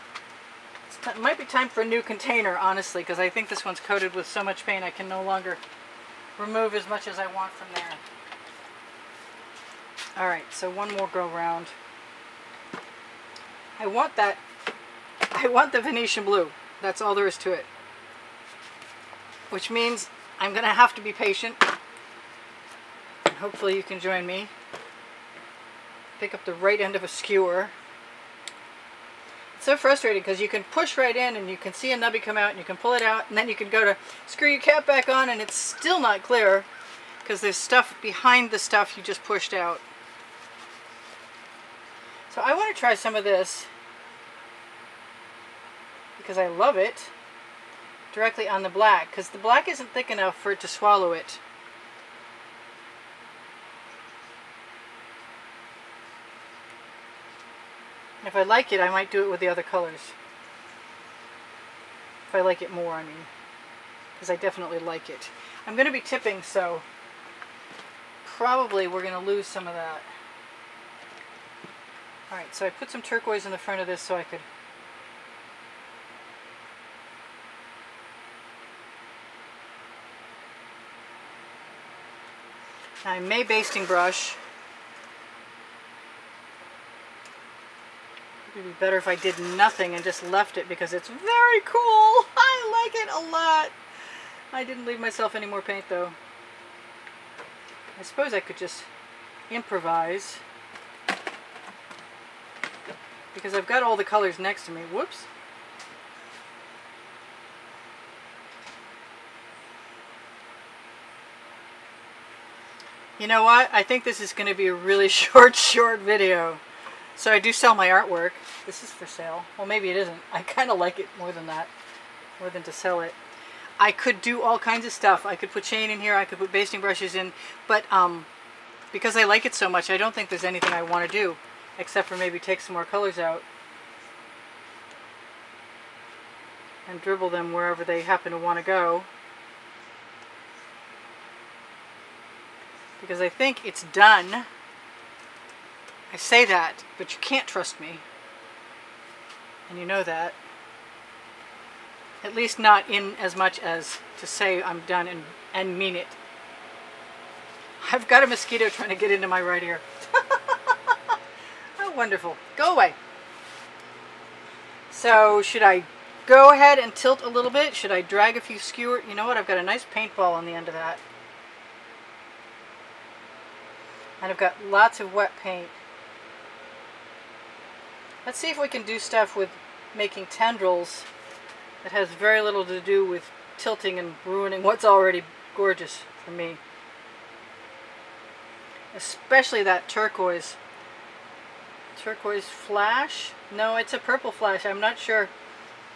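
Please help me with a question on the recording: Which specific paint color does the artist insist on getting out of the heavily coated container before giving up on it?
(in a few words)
Venetian blue.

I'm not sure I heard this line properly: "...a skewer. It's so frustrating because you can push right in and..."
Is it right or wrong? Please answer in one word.
right.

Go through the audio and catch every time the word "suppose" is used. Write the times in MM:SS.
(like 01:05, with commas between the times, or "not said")
01:38.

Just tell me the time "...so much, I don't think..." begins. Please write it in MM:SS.
02:09.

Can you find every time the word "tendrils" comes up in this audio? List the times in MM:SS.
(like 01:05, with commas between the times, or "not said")
03:00.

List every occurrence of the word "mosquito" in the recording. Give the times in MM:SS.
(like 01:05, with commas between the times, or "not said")
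02:38.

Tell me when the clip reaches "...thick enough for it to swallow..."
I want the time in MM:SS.
00:49.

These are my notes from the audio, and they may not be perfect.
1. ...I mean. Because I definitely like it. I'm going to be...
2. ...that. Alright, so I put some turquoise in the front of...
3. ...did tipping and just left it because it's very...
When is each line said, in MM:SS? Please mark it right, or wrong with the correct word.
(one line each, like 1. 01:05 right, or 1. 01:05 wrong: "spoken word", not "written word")
1. 01:02 right
2. 01:09 right
3. 01:29 wrong: "nothing", not "tipping".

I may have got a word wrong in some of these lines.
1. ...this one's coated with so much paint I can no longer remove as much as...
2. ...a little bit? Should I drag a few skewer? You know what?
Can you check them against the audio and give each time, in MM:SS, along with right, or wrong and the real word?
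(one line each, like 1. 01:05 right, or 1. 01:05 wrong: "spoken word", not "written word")
1. 00:03 right
2. 02:47 right.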